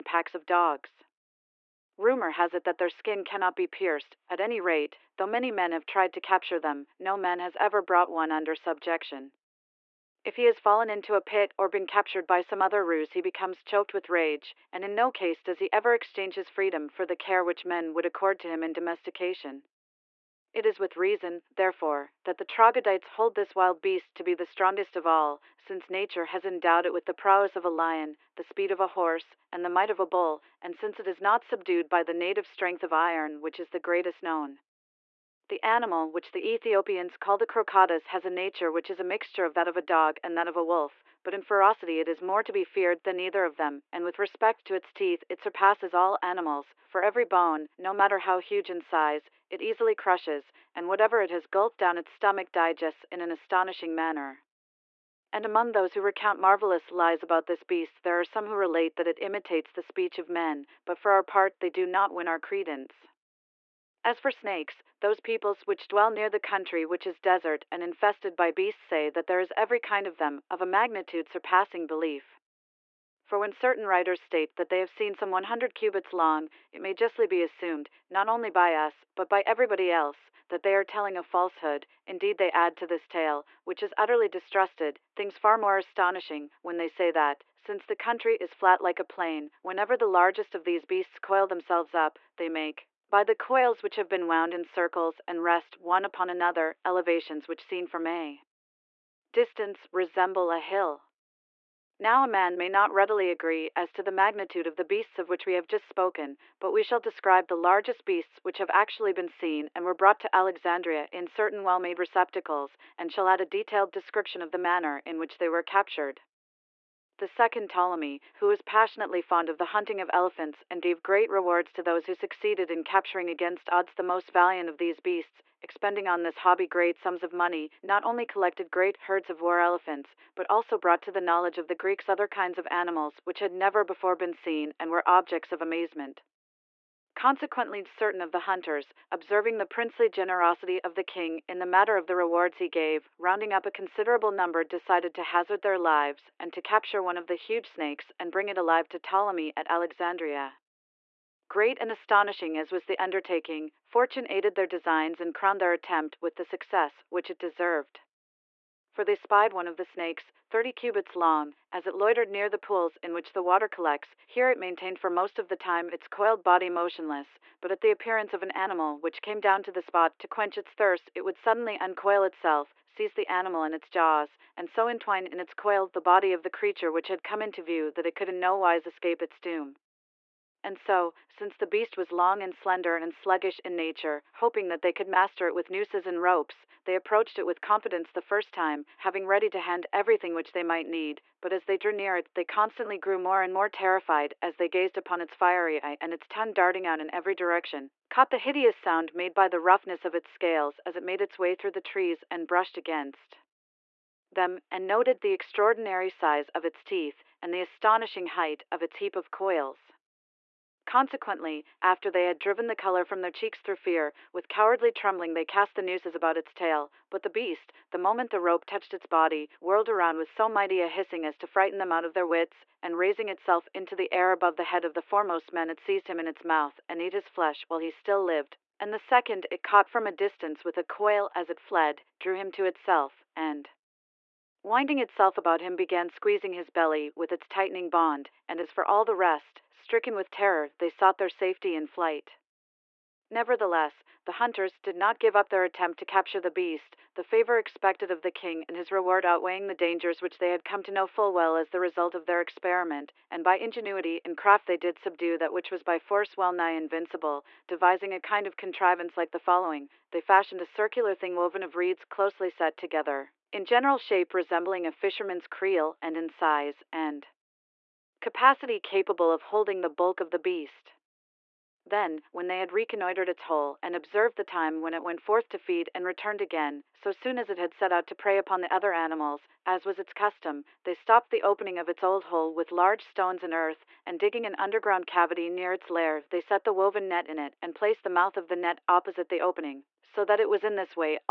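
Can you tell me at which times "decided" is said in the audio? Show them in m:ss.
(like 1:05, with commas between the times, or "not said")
2:24.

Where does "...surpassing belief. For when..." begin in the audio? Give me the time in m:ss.
1:11.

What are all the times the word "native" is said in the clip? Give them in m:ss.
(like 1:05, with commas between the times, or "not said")
0:32.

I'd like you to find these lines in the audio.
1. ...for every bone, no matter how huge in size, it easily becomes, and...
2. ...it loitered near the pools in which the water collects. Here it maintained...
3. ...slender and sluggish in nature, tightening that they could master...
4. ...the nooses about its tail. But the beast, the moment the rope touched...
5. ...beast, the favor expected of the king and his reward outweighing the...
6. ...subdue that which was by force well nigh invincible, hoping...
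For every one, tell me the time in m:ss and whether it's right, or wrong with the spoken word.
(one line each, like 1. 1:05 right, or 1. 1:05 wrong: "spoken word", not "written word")
1. 0:46 wrong: "crushes", not "becomes"
2. 2:41 right
3. 3:02 wrong: "hoping", not "tightening"
4. 3:35 right
5. 4:06 right
6. 4:14 wrong: "devising", not "hoping".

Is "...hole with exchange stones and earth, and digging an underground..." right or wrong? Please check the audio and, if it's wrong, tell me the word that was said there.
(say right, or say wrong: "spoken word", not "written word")
wrong: "large", not "exchange".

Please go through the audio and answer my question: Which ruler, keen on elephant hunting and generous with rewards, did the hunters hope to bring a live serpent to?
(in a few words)
the second Ptolemy.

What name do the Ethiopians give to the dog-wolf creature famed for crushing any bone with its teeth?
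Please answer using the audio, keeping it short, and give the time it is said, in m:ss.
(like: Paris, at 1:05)
crocottas, at 0:37.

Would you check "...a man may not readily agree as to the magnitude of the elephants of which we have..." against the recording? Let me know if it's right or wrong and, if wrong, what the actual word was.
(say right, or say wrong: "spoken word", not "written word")
wrong: "beasts", not "elephants".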